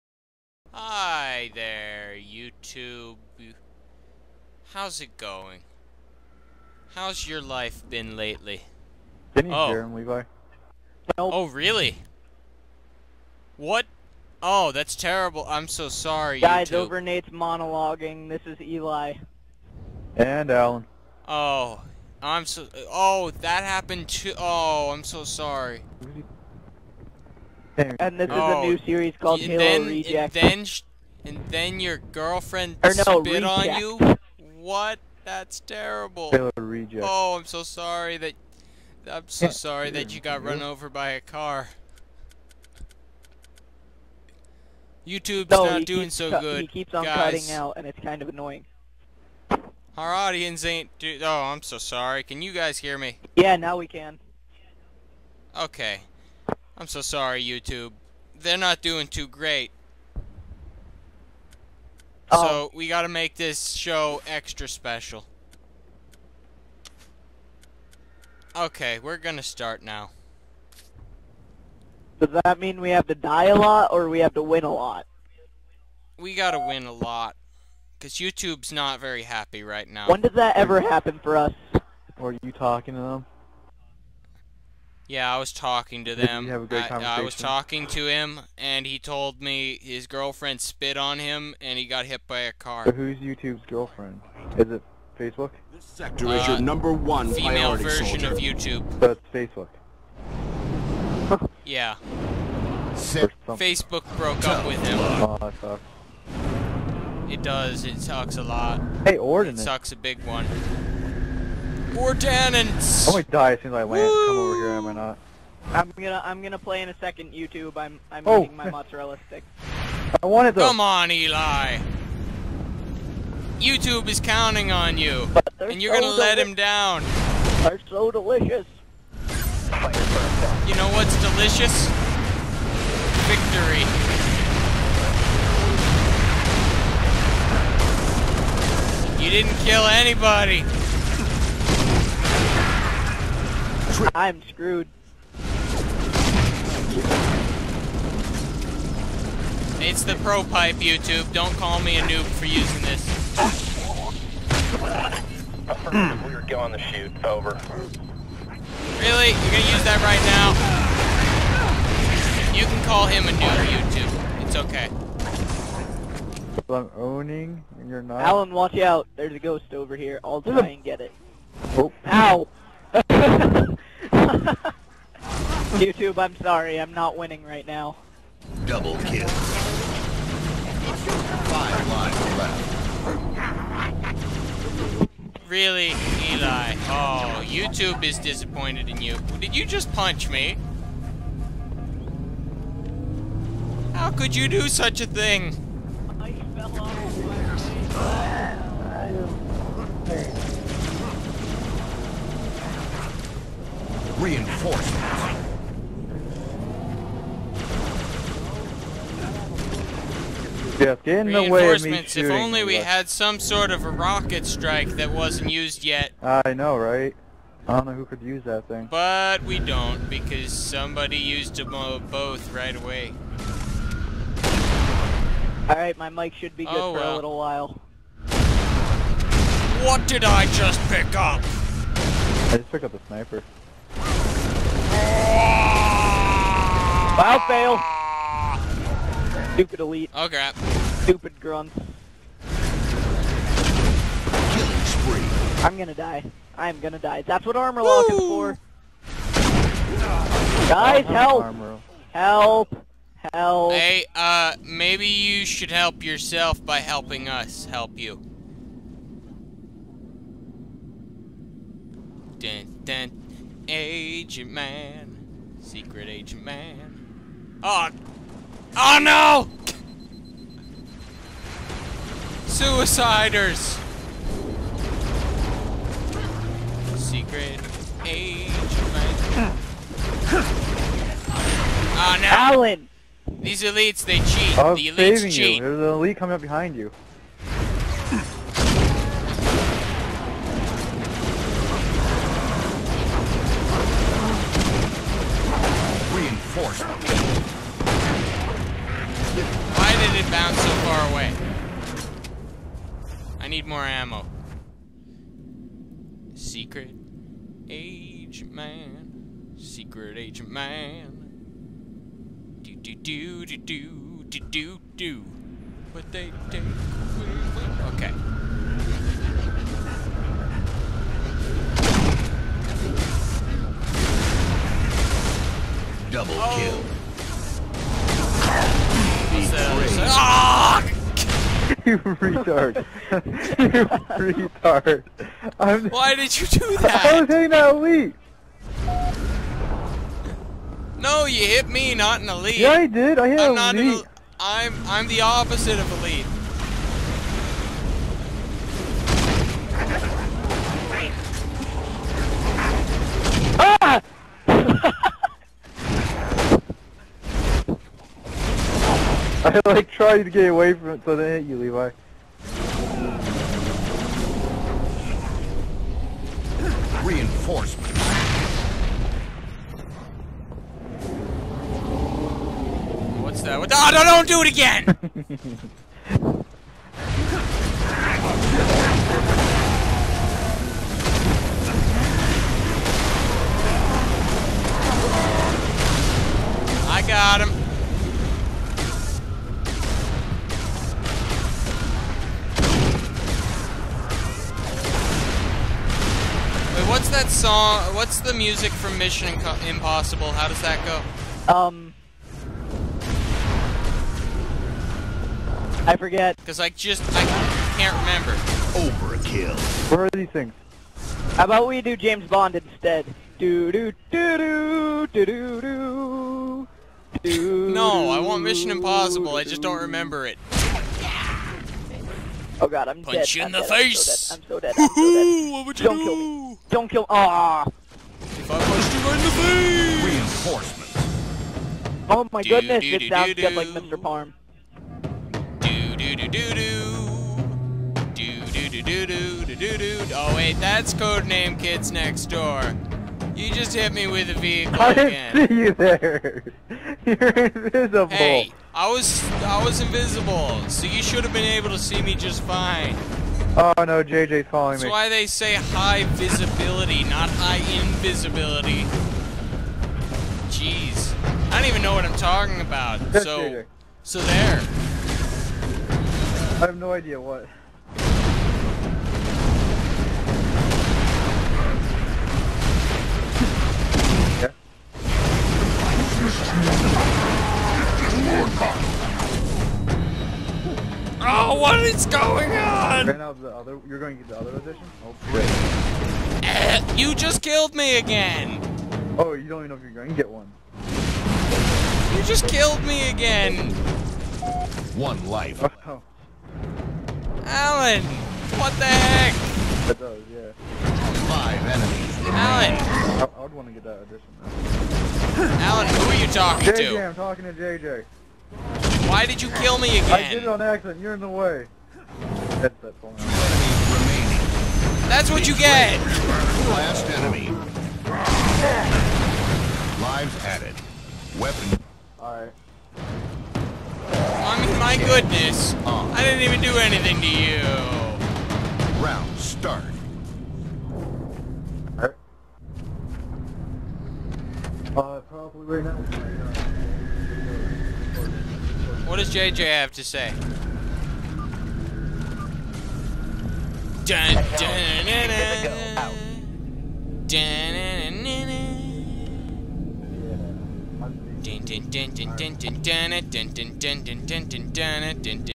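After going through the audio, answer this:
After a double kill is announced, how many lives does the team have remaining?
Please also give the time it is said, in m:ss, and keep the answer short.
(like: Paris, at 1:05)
5, at 3:01.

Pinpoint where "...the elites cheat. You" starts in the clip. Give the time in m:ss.
4:44.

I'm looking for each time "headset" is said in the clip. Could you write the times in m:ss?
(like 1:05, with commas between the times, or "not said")
8:32.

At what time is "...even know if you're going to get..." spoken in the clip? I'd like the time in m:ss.
8:09.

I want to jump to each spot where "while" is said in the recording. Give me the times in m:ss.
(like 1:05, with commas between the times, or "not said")
3:47.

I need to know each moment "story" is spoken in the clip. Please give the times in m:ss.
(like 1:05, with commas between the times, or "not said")
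not said.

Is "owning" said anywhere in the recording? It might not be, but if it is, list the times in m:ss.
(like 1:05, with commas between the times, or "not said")
2:46.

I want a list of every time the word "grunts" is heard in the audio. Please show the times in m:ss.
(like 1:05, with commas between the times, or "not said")
4:01.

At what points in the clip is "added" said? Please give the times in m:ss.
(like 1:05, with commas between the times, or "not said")
8:40.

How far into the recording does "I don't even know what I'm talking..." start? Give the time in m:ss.
7:41.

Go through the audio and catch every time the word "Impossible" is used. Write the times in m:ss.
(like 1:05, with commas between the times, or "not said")
6:39, 6:58.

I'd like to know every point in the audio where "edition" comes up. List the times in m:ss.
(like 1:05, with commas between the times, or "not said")
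8:04, 8:24.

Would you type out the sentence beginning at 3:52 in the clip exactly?
I just picked up a sniper.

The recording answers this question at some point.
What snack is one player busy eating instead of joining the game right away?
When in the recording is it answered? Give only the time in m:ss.
1:58.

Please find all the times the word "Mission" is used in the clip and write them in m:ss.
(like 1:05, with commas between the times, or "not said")
6:38, 6:58.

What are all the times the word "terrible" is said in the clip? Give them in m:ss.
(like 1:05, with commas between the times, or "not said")
0:14, 0:35.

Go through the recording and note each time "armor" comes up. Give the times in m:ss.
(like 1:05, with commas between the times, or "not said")
4:07.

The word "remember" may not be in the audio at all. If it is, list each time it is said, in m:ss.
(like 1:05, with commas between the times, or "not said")
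6:47, 6:59.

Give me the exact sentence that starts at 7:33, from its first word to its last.
Oh no, JJ's following That's me.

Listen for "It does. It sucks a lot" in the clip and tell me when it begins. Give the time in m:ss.
1:47.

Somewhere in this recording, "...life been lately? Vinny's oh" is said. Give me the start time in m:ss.
0:07.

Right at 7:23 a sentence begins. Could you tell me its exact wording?
You just hit me with a vehicle again.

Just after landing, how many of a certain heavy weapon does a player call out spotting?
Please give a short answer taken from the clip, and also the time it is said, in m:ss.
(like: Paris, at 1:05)
4, at 1:51.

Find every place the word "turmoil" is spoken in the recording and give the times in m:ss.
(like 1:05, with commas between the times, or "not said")
not said.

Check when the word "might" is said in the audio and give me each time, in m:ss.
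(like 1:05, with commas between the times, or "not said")
1:53.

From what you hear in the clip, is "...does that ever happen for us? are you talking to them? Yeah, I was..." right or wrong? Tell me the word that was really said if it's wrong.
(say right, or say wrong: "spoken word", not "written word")
right.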